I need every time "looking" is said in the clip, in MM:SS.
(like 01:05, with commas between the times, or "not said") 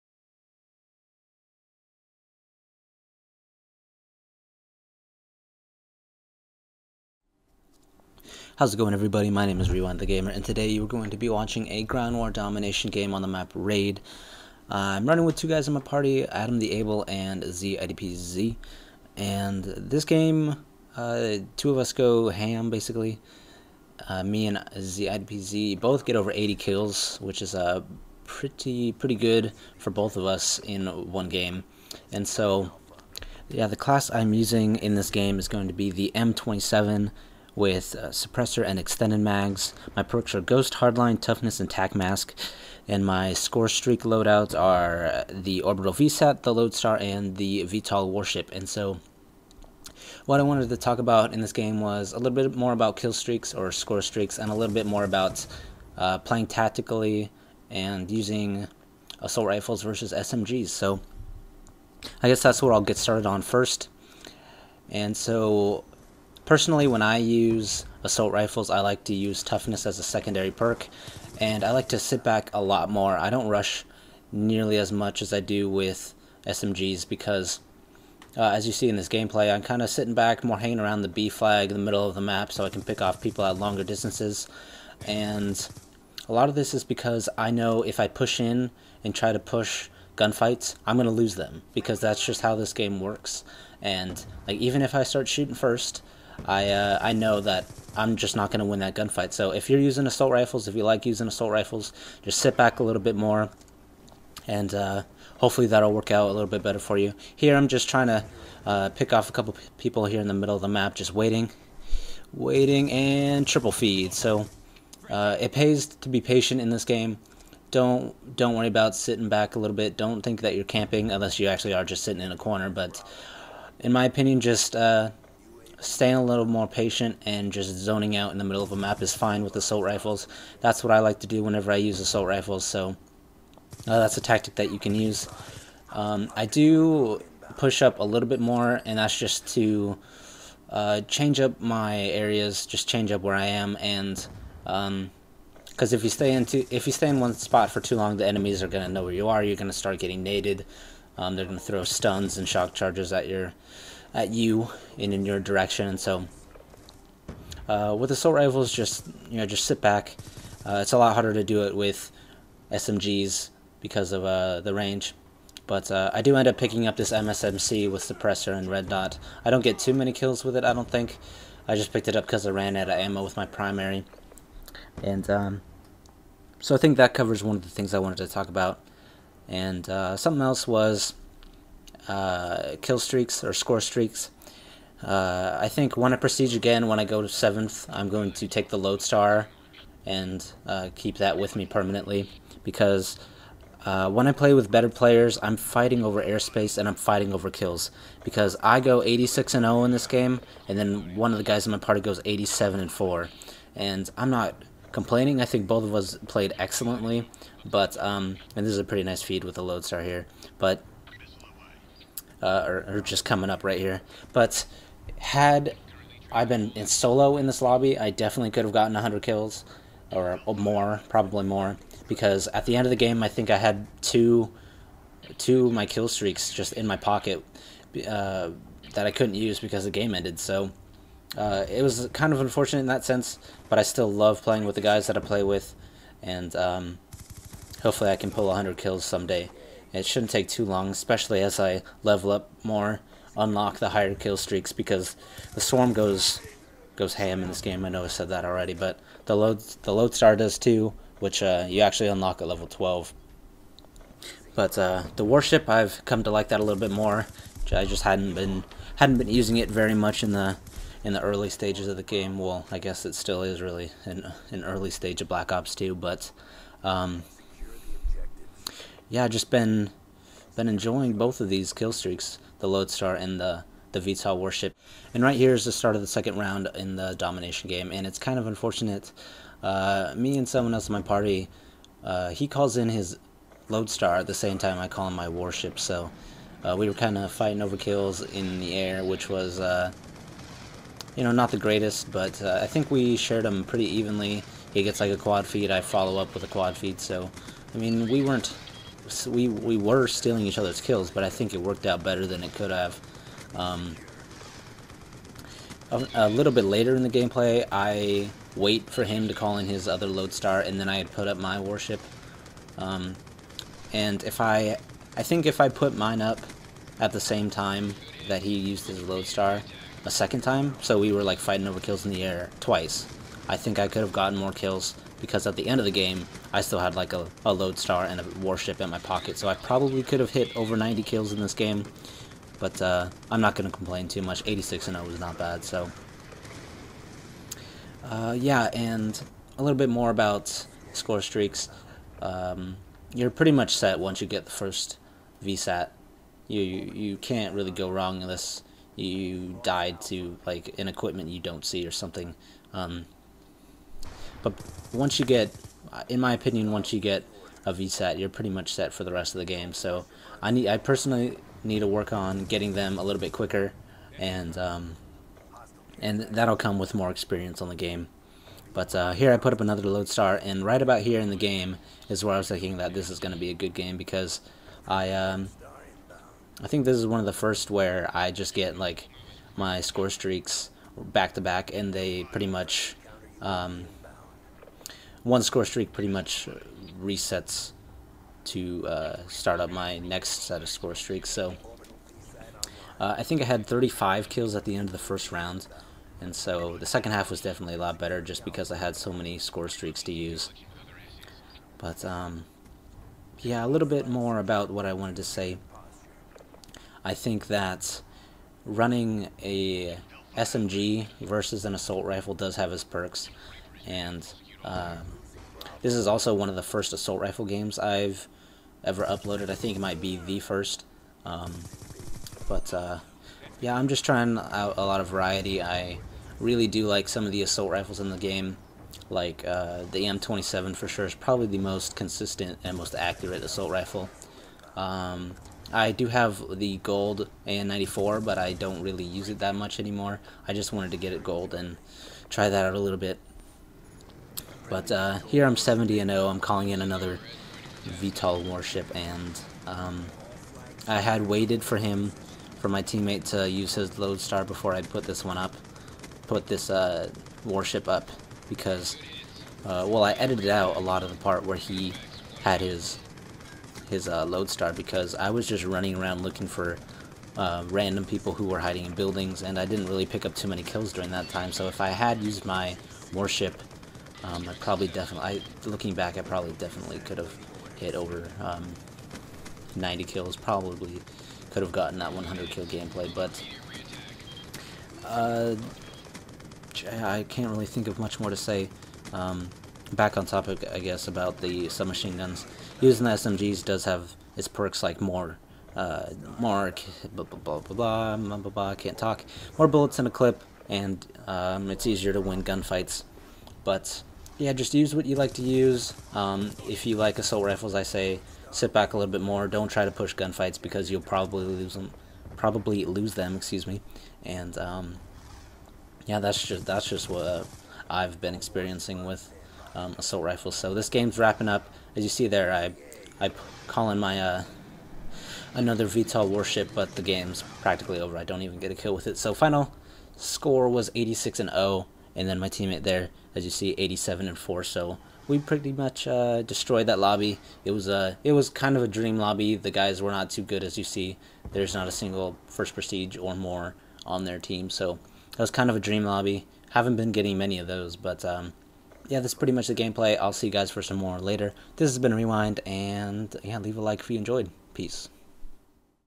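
07:46, 07:55.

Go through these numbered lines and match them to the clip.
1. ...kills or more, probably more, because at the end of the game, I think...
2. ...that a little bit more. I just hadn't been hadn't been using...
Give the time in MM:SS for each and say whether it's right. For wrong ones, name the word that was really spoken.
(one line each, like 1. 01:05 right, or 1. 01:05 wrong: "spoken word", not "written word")
1. 03:39 right
2. 04:16 right.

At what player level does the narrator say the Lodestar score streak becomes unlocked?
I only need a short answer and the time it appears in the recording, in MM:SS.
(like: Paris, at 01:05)
12, at 04:12.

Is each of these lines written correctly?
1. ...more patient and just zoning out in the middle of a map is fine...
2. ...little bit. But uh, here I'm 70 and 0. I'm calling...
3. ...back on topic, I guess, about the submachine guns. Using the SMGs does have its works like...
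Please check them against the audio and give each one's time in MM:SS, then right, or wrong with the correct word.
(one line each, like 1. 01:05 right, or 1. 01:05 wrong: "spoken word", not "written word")
1. 02:06 right
2. 07:22 right
3. 08:09 wrong: "perks", not "works".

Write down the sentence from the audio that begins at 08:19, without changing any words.
More bullets in a clip, and um, it's easier to win gunfights.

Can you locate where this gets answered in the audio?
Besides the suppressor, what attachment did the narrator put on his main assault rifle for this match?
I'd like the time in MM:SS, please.
00:38.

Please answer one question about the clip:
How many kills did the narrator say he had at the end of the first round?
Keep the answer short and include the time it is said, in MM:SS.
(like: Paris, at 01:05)
35, at 06:33.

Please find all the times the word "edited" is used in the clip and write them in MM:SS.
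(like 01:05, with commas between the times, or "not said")
07:40.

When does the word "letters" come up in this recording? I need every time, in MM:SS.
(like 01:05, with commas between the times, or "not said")
not said.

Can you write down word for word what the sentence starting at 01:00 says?
So I guess that's what I'll get started on first.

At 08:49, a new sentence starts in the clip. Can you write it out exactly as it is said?
So final score was 86 and 0 and then my teammate there, as you see, 87 and 4.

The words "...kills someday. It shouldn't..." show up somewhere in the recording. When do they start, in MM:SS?
03:58.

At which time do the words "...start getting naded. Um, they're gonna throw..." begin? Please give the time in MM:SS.
02:29.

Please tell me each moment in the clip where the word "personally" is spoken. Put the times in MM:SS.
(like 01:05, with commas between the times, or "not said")
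01:06, 06:00.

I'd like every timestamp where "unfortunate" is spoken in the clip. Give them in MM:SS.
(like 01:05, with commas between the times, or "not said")
03:52, 04:38.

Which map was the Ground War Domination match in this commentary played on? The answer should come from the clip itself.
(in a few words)
Raid.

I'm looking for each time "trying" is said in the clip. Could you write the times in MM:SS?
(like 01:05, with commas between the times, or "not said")
01:47, 07:04.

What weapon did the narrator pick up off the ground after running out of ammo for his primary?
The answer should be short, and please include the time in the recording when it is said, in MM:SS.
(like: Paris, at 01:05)
MSMC, at 02:47.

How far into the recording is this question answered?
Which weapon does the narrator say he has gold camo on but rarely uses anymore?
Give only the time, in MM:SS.
07:17.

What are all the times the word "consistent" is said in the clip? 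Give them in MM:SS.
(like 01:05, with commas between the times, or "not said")
07:11.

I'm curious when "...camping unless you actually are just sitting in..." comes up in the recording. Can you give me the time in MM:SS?
02:00.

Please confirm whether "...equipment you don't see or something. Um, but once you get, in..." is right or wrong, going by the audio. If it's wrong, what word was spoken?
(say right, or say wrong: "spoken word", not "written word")
right.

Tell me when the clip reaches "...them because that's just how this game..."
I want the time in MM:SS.
01:31.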